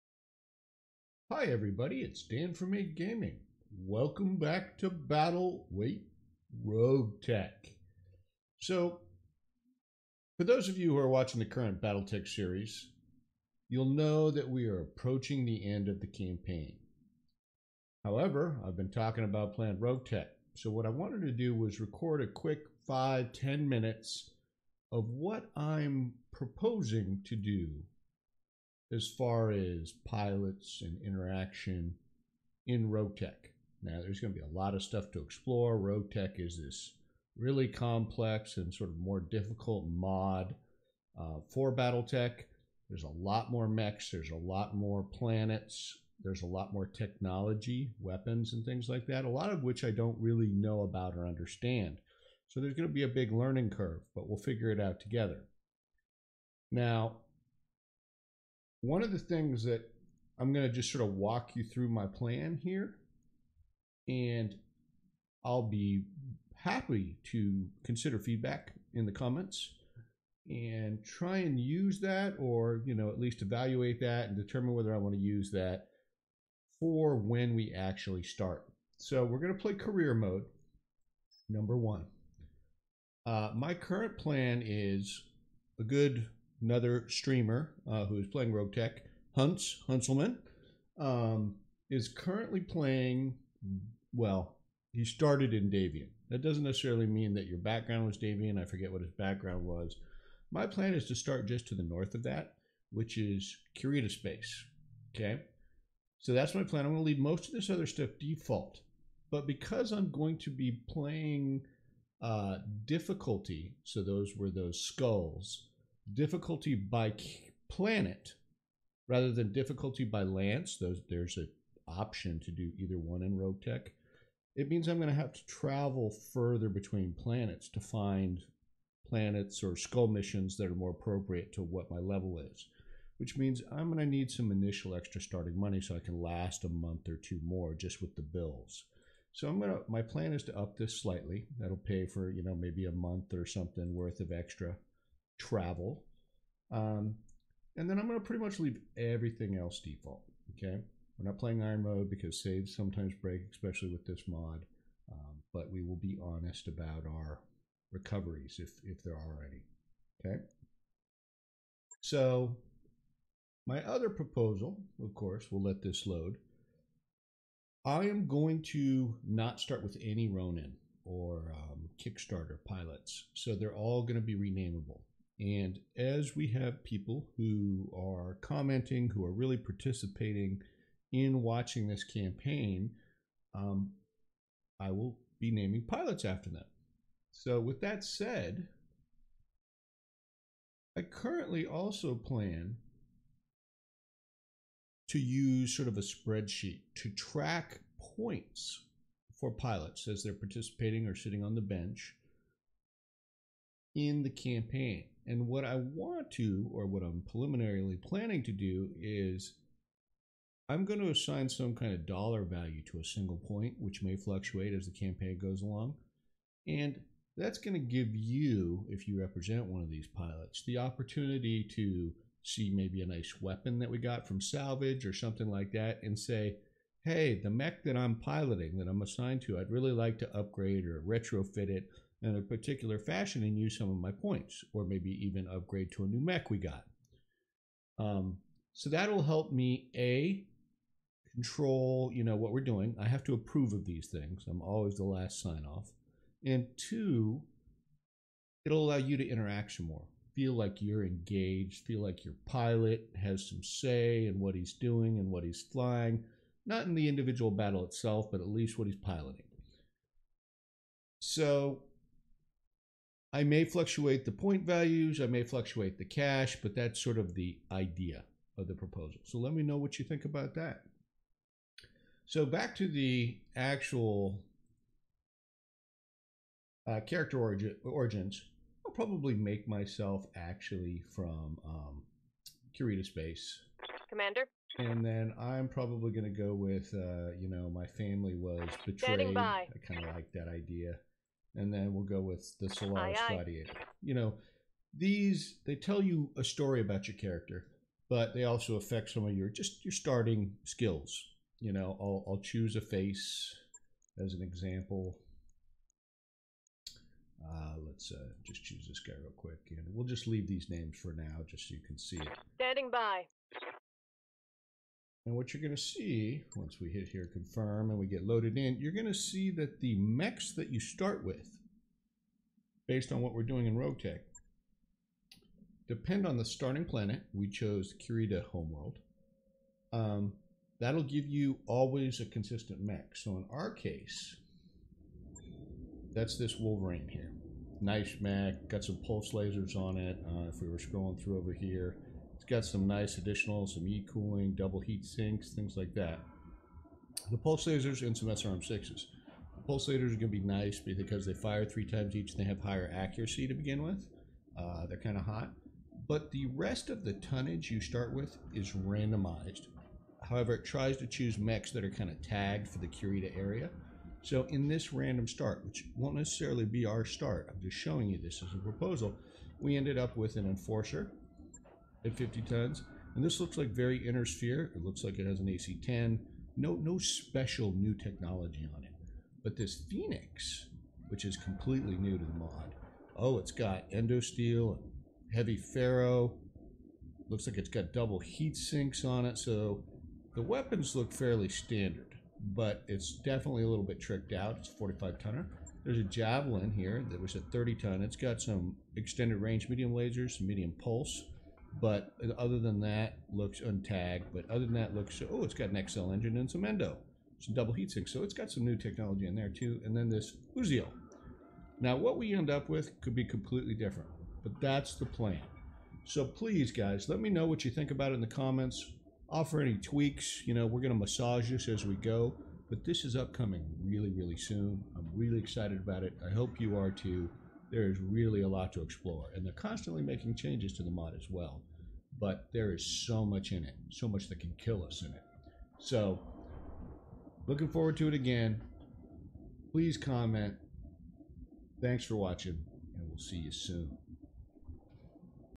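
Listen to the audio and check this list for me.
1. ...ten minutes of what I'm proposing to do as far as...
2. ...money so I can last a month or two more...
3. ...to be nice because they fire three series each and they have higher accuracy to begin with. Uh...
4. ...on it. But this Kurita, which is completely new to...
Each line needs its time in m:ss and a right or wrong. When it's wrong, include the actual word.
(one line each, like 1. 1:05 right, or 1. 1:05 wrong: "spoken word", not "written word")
1. 0:23 right
2. 2:15 right
3. 5:50 wrong: "times", not "series"
4. 6:18 wrong: "Phoenix", not "Kurita".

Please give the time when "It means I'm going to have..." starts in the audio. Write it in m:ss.
2:04.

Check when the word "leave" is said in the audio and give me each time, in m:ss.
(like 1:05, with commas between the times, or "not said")
1:47, 2:28, 5:10.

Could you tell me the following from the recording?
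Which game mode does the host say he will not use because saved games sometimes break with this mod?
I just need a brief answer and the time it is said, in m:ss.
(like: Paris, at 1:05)
iron mode, at 2:31.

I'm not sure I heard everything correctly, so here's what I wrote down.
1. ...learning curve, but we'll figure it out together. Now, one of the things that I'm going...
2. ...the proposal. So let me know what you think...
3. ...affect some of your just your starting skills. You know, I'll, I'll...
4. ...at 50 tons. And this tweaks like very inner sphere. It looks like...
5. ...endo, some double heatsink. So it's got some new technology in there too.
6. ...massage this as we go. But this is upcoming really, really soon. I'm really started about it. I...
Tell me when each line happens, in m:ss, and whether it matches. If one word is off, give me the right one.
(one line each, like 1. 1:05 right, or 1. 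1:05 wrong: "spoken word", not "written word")
1. 0:53 right
2. 4:28 right
3. 4:58 right
4. 6:12 wrong: "looks", not "tweaks"
5. 6:46 right
6. 7:00 wrong: "excited", not "started".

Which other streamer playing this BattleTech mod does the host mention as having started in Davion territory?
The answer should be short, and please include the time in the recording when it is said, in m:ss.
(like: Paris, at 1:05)
Hunts Hunselman, at 1:29.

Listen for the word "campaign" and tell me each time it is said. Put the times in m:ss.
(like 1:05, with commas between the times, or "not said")
0:16, 3:02, 3:24, 3:34.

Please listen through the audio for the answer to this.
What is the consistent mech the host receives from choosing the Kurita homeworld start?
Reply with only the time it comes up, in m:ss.
5:36.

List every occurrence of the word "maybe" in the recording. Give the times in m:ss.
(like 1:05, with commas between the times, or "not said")
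2:22, 3:42, 3:54.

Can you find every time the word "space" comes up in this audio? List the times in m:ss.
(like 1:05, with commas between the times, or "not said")
1:44, 4:43.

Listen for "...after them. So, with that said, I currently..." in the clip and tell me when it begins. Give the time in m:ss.
3:06.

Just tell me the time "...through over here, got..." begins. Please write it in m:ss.
5:41.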